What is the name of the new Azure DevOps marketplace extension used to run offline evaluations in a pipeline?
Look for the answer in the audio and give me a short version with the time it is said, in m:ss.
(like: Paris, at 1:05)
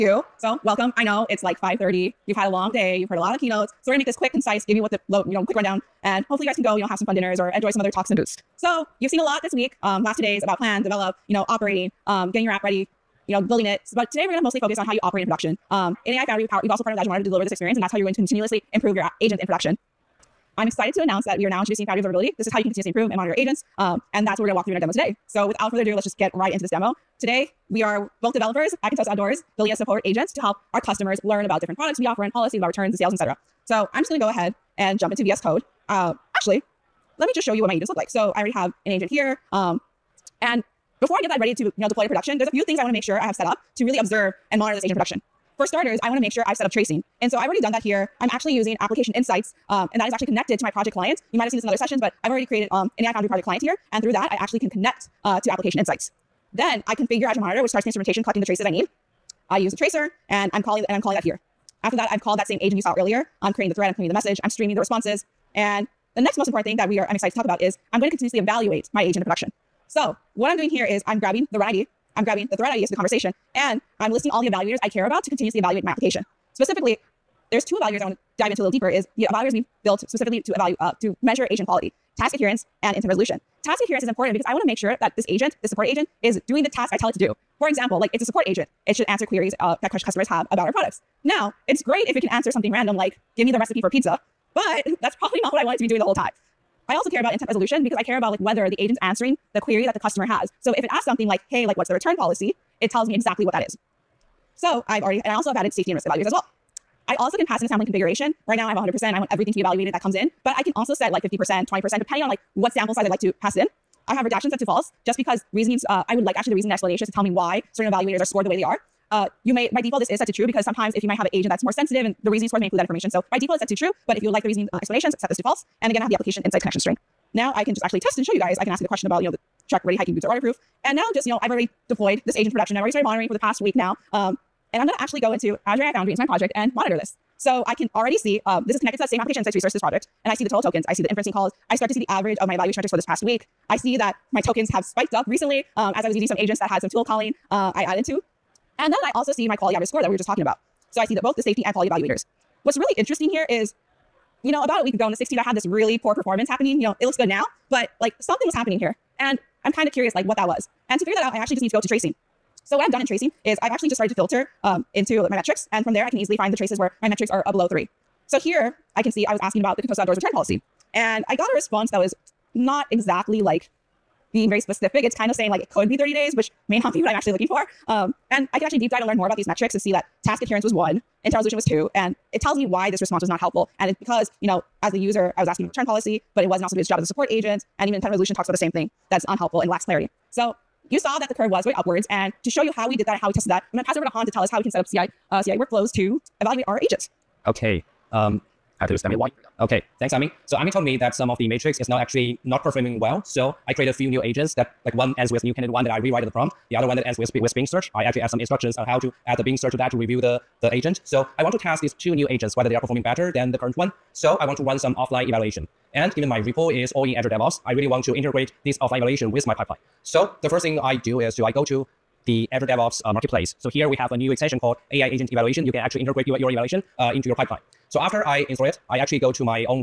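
AI agent evaluation, at 3:44.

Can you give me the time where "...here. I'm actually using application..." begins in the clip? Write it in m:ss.
0:47.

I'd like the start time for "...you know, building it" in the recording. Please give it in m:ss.
0:13.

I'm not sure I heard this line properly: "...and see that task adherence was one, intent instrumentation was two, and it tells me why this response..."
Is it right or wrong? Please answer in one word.
wrong.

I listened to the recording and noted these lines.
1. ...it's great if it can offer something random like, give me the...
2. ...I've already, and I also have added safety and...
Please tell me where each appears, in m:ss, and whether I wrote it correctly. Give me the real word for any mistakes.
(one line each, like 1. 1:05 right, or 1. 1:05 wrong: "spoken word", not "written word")
1. 1:31 wrong: "answer", not "offer"
2. 1:44 right.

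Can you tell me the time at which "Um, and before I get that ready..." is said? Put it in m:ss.
0:39.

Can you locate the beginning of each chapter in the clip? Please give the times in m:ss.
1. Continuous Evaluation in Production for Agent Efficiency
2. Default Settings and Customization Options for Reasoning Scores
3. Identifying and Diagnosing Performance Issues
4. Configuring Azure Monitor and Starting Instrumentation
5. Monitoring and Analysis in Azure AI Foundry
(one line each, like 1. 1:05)
1. 1:05
2. 1:59
3. 3:04
4. 0:56
5. 2:12.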